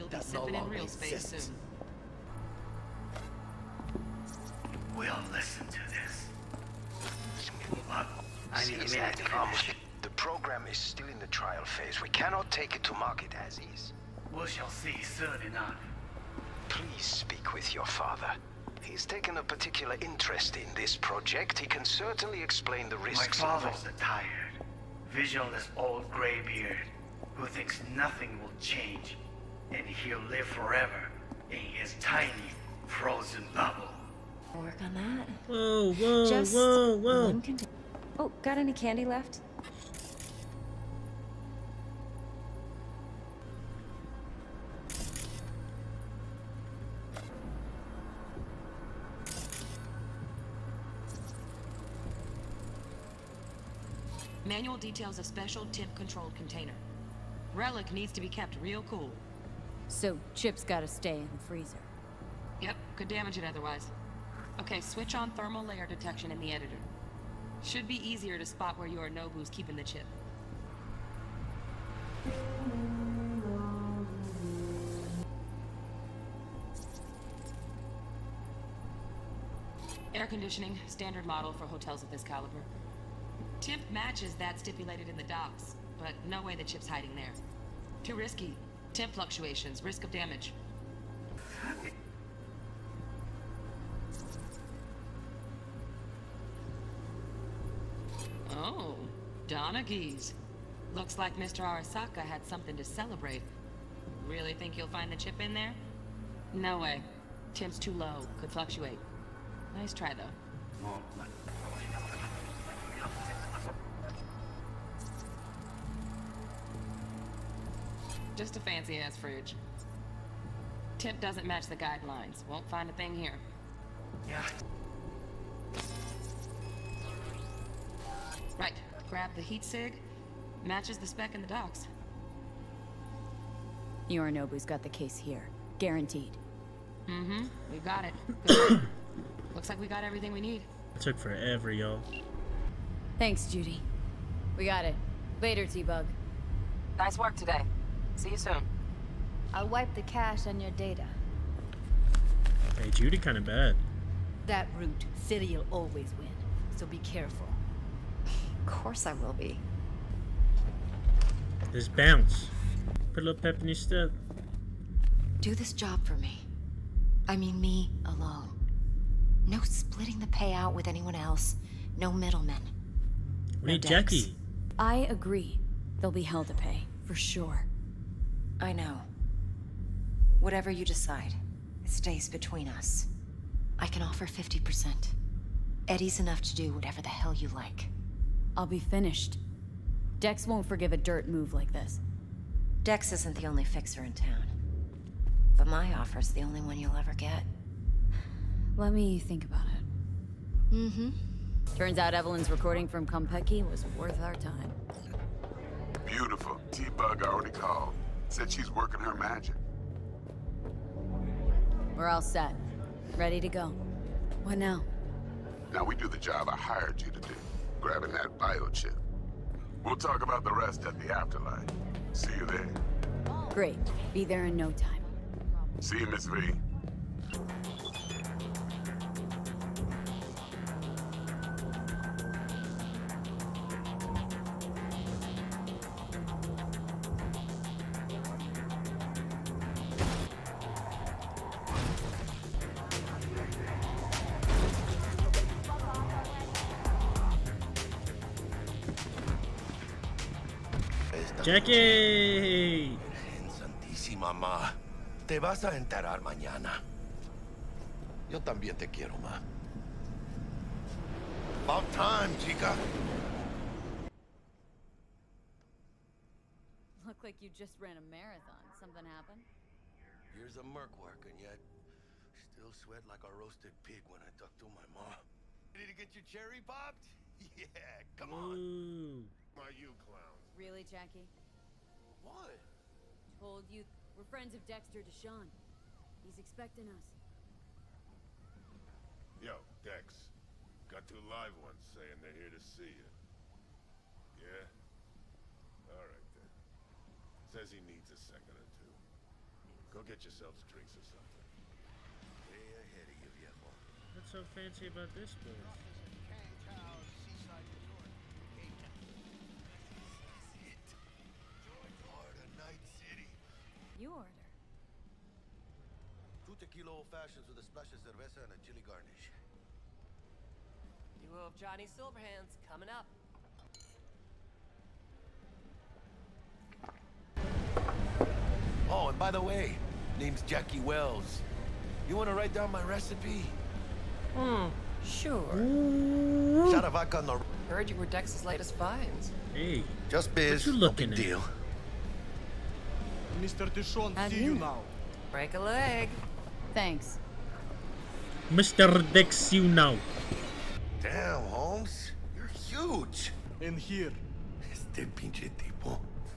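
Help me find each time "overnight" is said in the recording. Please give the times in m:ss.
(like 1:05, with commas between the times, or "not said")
not said.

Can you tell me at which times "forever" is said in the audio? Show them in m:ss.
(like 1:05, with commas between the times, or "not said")
0:30, 2:21.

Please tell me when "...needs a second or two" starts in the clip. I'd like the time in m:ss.
4:57.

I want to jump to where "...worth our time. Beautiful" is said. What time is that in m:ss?
3:23.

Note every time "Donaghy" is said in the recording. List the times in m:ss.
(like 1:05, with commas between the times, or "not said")
1:39.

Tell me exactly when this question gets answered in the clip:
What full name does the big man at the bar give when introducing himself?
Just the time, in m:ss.
5:30.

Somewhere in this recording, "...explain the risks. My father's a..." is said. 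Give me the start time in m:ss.
0:22.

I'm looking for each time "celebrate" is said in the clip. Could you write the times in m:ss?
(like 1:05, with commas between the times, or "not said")
1:42.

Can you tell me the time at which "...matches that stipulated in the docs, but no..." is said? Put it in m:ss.
1:23.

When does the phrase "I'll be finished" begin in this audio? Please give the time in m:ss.
3:08.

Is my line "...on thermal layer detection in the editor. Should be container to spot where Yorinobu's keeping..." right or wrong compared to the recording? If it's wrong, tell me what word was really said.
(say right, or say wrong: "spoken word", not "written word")
wrong: "easier", not "container".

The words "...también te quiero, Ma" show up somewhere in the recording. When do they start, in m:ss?
4:18.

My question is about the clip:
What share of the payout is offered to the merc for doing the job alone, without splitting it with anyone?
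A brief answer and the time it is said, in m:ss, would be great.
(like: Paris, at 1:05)
50%, at 3:04.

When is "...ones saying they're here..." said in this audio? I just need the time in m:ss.
4:51.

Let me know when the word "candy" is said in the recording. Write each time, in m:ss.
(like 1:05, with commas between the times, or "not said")
0:38.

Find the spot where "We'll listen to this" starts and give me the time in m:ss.
0:04.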